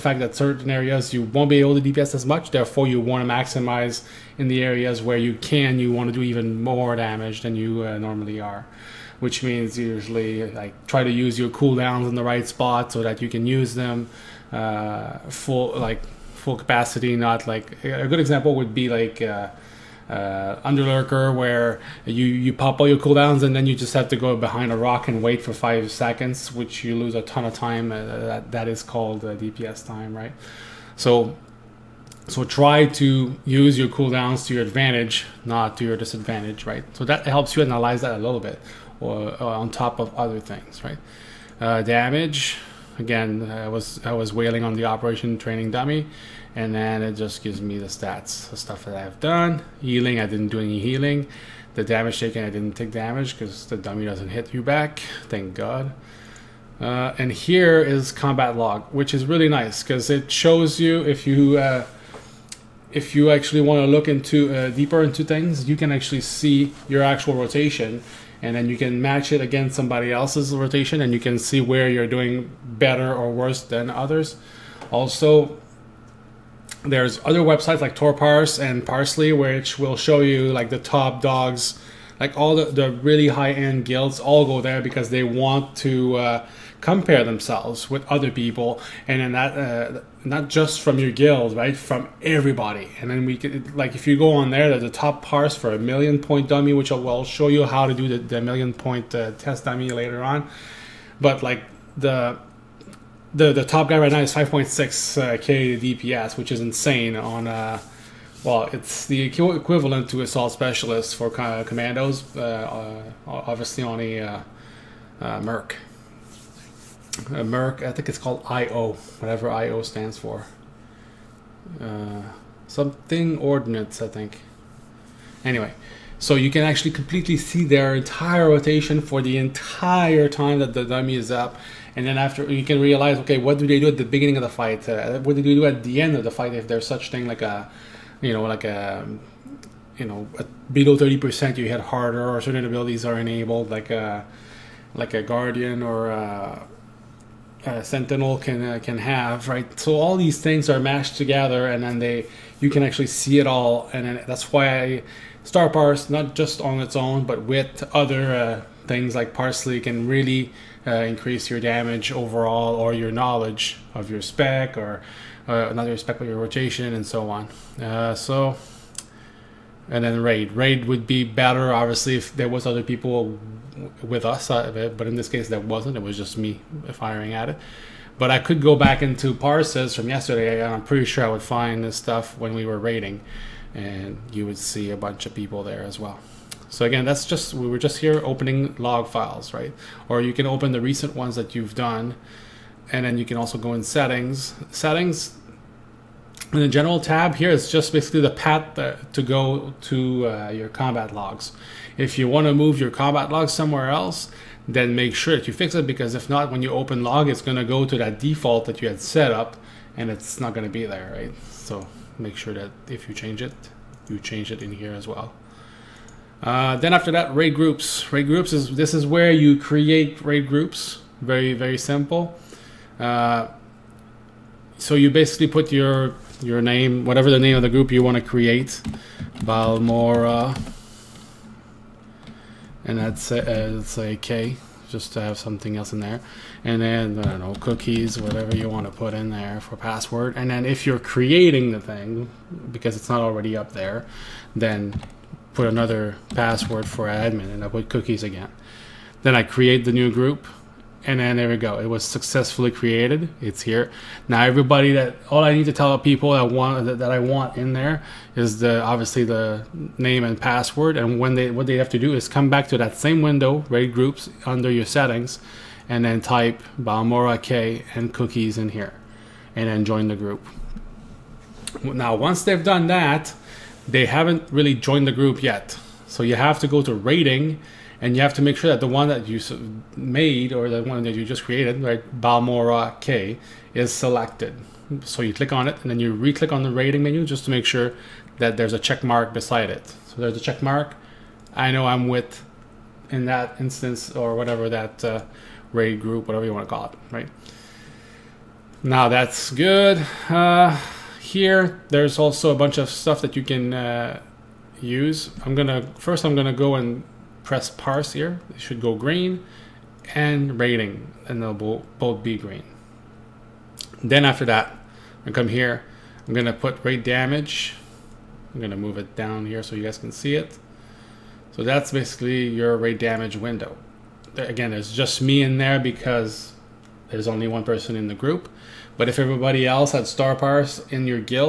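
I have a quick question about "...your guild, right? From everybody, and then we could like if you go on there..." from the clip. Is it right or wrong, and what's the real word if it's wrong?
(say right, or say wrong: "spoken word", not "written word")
right.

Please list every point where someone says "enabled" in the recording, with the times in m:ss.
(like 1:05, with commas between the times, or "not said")
2:23.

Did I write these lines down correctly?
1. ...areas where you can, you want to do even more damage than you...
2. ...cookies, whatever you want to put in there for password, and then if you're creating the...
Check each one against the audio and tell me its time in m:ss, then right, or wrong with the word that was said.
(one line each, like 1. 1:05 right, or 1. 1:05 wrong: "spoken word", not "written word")
1. 0:04 right
2. 3:57 right.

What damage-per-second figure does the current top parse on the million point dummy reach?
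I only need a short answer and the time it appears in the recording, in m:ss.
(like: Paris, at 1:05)
5.6K, at 1:44.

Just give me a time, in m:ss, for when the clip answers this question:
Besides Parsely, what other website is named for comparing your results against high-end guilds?
1:17.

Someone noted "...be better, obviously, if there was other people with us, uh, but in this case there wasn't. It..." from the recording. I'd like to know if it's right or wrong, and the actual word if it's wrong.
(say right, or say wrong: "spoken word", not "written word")
right.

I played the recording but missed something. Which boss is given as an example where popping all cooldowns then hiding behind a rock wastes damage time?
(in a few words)
Underlurker.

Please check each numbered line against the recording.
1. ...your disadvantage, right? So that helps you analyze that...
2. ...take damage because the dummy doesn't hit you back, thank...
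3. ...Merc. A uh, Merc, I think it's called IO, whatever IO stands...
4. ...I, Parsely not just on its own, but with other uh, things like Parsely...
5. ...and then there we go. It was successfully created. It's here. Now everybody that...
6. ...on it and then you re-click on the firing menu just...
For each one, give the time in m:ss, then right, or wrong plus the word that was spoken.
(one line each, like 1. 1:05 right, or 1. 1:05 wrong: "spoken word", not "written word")
1. 0:35 right
2. 0:52 right
3. 1:55 right
4. 2:34 wrong: "Star", not "Parsely"
5. 4:11 right
6. 4:45 wrong: "raiding", not "firing".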